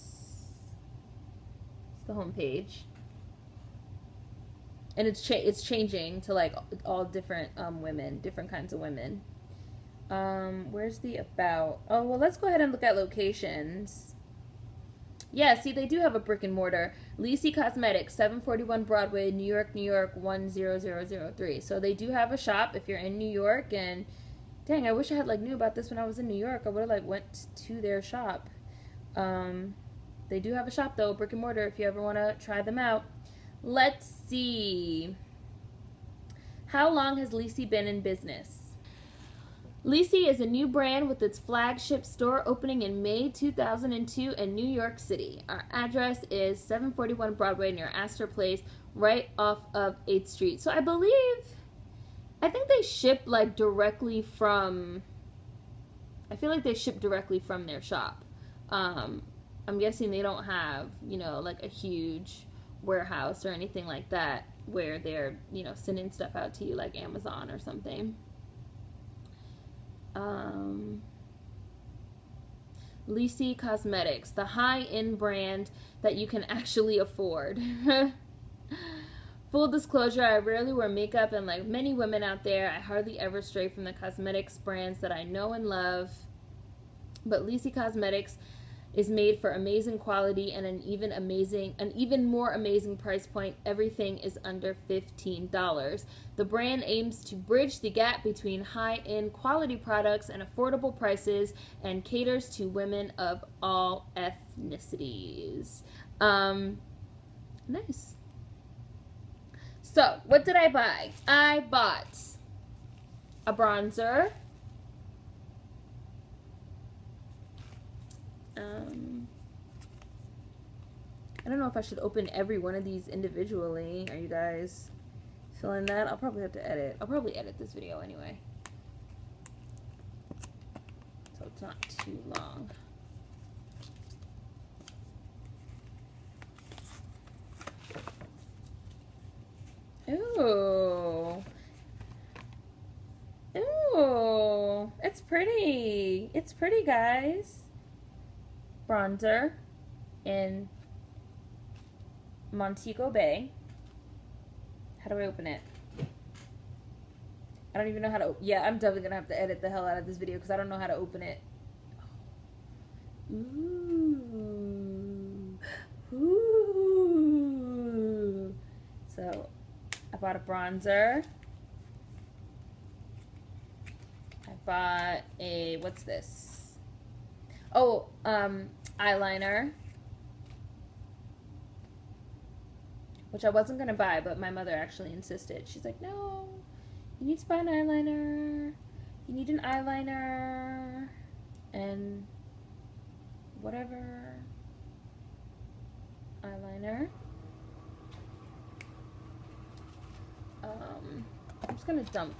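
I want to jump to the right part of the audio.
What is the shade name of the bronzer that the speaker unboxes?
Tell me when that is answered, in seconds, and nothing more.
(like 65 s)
152 s.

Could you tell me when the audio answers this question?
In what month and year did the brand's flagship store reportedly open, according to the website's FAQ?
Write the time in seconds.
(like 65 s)
43 s.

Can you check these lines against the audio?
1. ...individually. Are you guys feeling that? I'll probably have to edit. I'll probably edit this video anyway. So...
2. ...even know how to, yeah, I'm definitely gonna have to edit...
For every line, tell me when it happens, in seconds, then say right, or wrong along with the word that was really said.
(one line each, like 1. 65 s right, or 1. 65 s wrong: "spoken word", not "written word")
1. 123 s right
2. 157 s right.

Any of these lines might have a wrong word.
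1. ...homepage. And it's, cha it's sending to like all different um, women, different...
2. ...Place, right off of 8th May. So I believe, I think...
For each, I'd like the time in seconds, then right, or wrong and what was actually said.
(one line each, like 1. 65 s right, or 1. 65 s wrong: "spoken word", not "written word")
1. 2 s wrong: "changing", not "sending"
2. 48 s wrong: "Street", not "May".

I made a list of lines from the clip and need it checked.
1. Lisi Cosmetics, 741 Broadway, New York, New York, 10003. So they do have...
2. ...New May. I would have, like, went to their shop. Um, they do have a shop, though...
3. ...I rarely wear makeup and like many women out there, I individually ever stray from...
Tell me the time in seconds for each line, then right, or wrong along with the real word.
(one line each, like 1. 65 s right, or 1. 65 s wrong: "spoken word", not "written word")
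1. 17 s right
2. 26 s wrong: "York", not "May"
3. 80 s wrong: "hardly", not "individually".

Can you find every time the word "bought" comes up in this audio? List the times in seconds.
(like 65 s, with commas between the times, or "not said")
111 s, 170 s, 174 s.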